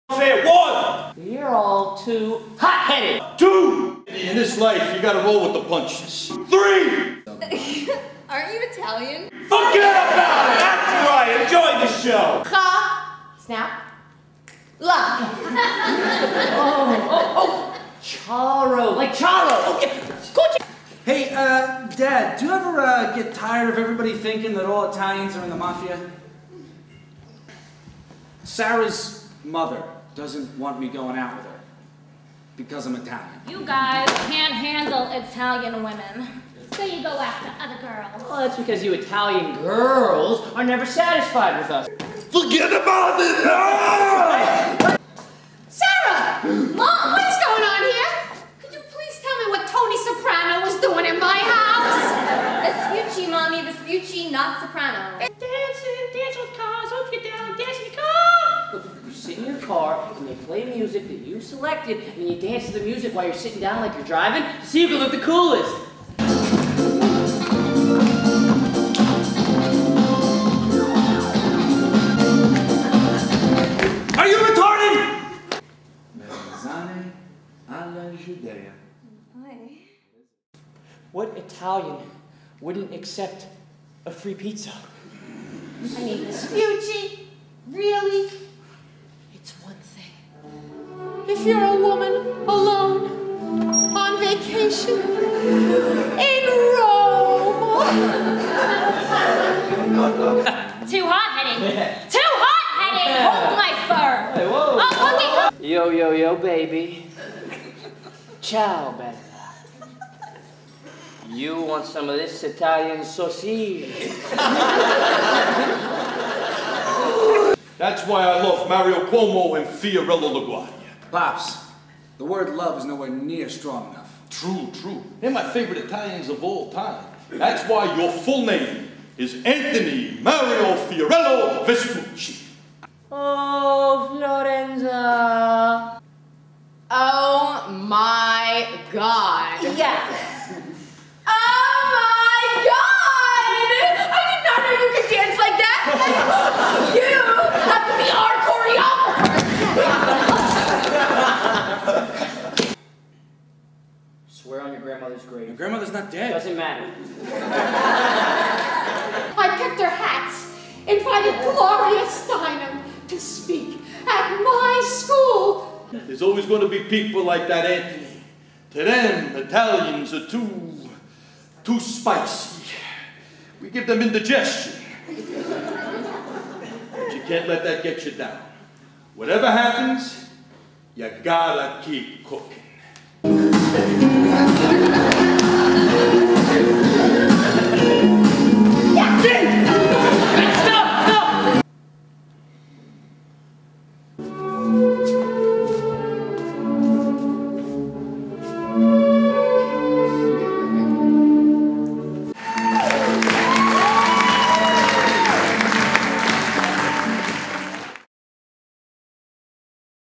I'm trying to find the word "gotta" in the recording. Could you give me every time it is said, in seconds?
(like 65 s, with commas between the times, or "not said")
5 s, 181 s.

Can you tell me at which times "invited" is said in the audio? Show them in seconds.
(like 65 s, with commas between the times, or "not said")
160 s.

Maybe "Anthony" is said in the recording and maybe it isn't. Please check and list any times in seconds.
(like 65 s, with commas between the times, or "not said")
129 s, 167 s.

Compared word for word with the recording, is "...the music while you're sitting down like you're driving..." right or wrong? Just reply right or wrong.
right.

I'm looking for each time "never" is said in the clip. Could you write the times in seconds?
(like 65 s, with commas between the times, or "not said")
40 s.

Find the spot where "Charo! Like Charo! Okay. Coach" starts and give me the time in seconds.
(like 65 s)
18 s.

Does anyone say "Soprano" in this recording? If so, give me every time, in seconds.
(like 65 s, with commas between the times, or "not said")
49 s, 54 s.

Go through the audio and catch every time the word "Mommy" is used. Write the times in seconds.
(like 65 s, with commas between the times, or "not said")
53 s.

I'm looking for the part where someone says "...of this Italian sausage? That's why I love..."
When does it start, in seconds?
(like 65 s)
112 s.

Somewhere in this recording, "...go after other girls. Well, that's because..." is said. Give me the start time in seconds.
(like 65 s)
37 s.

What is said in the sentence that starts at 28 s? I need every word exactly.
Sarah's mother doesn't want me going out with her because I'm Italian.